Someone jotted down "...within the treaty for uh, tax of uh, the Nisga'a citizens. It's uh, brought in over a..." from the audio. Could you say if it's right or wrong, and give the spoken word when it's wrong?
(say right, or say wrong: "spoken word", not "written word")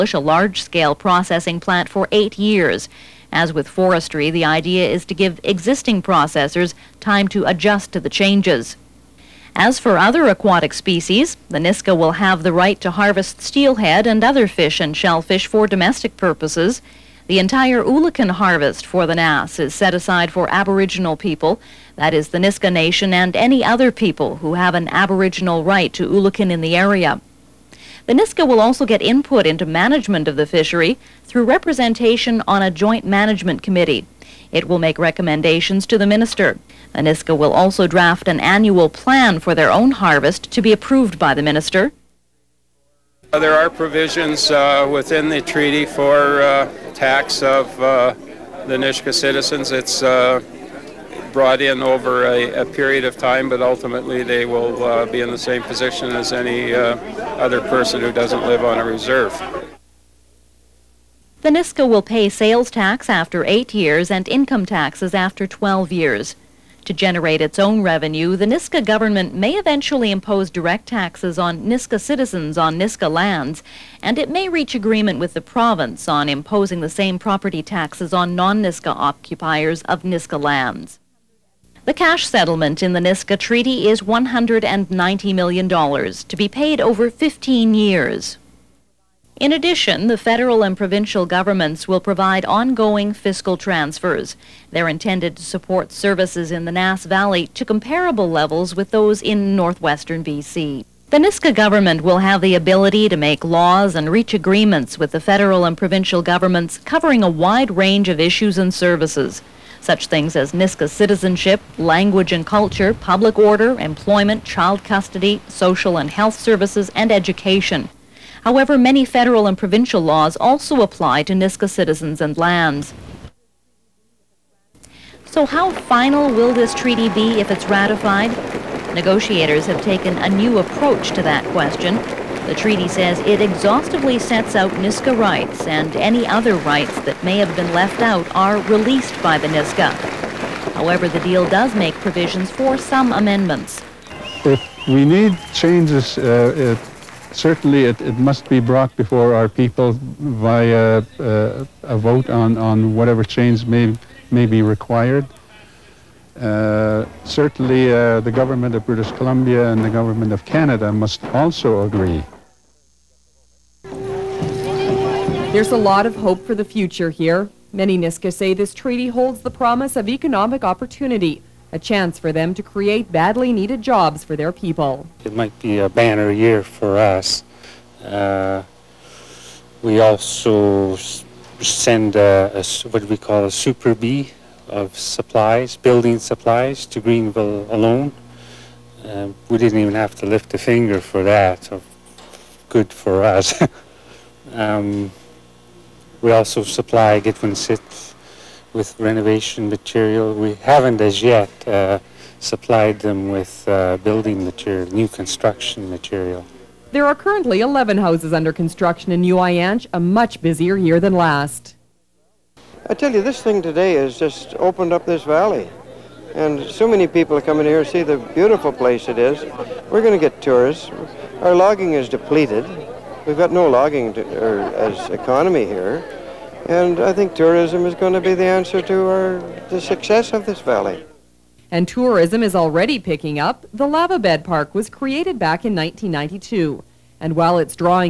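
right.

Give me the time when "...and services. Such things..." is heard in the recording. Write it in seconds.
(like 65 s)
108 s.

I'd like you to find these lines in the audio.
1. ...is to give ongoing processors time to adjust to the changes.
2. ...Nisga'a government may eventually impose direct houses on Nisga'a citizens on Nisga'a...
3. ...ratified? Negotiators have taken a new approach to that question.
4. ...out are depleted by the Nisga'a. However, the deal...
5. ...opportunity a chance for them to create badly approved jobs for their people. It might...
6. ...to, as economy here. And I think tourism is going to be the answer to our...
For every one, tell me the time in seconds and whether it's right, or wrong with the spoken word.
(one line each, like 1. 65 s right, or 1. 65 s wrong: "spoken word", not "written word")
1. 4 s wrong: "existing", not "ongoing"
2. 68 s wrong: "taxes", not "houses"
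3. 127 s right
4. 138 s wrong: "released", not "depleted"
5. 170 s wrong: "needed", not "approved"
6. 224 s right.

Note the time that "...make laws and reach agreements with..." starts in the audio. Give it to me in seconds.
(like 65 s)
103 s.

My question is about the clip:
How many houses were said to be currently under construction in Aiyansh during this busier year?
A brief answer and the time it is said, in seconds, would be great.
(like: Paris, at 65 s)
11, at 207 s.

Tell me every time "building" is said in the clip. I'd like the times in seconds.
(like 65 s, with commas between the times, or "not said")
185 s, 203 s.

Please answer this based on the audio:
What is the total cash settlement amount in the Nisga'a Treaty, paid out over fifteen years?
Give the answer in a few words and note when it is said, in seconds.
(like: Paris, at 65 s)
$190 million, at 84 s.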